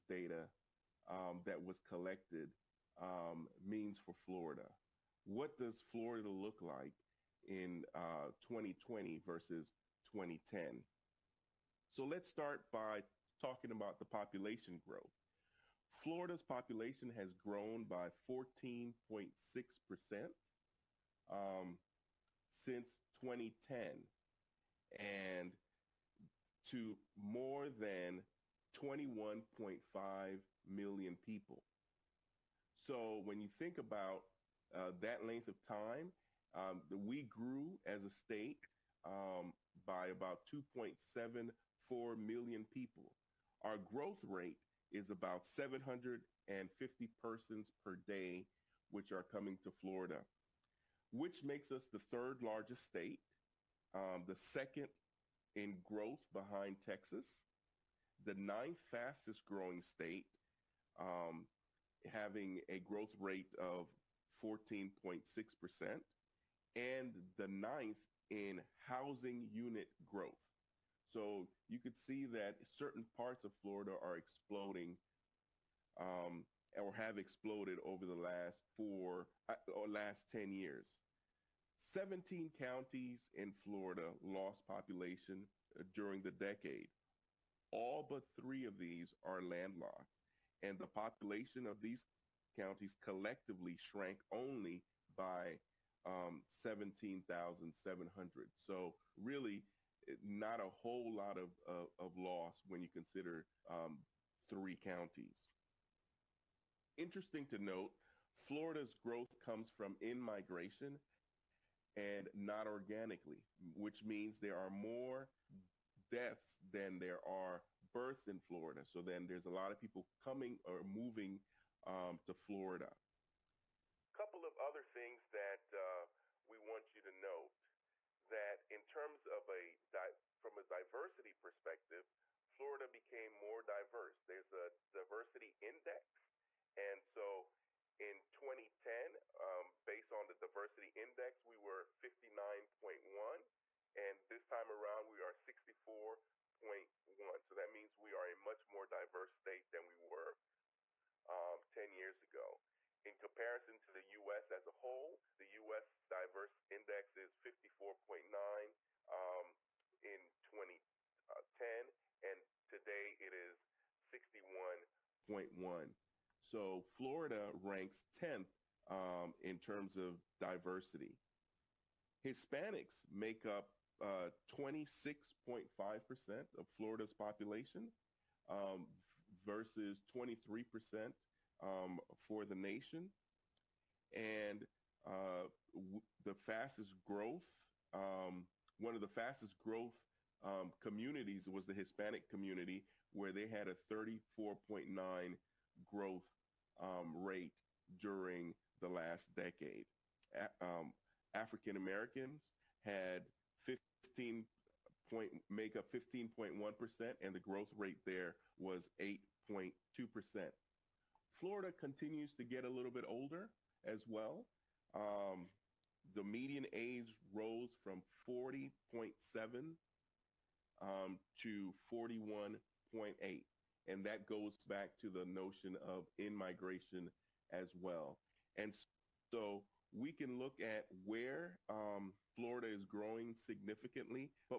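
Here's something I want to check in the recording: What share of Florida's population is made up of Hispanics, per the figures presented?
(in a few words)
26.5%.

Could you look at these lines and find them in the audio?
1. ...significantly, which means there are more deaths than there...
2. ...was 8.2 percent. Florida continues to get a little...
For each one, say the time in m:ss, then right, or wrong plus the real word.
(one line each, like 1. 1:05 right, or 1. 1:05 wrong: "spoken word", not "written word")
1. 1:52 wrong: "organically", not "significantly"
2. 3:28 right.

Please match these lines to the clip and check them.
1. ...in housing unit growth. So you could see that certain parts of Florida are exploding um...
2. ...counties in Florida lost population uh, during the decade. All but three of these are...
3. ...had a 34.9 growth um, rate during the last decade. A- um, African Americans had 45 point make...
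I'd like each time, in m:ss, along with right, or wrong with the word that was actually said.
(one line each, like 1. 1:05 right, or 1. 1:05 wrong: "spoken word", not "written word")
1. 1:08 right
2. 1:22 right
3. 3:13 wrong: "15", not "45".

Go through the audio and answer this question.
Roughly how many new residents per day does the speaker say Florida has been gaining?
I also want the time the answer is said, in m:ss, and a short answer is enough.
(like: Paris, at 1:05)
750, at 0:45.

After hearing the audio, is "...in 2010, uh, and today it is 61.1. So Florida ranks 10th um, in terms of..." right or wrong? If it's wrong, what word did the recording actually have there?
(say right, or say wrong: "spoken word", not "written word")
right.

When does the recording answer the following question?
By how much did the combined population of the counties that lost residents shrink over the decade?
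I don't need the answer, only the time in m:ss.
1:36.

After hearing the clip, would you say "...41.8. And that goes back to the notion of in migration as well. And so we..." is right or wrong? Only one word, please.
right.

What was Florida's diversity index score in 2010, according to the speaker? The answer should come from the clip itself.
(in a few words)
59.1.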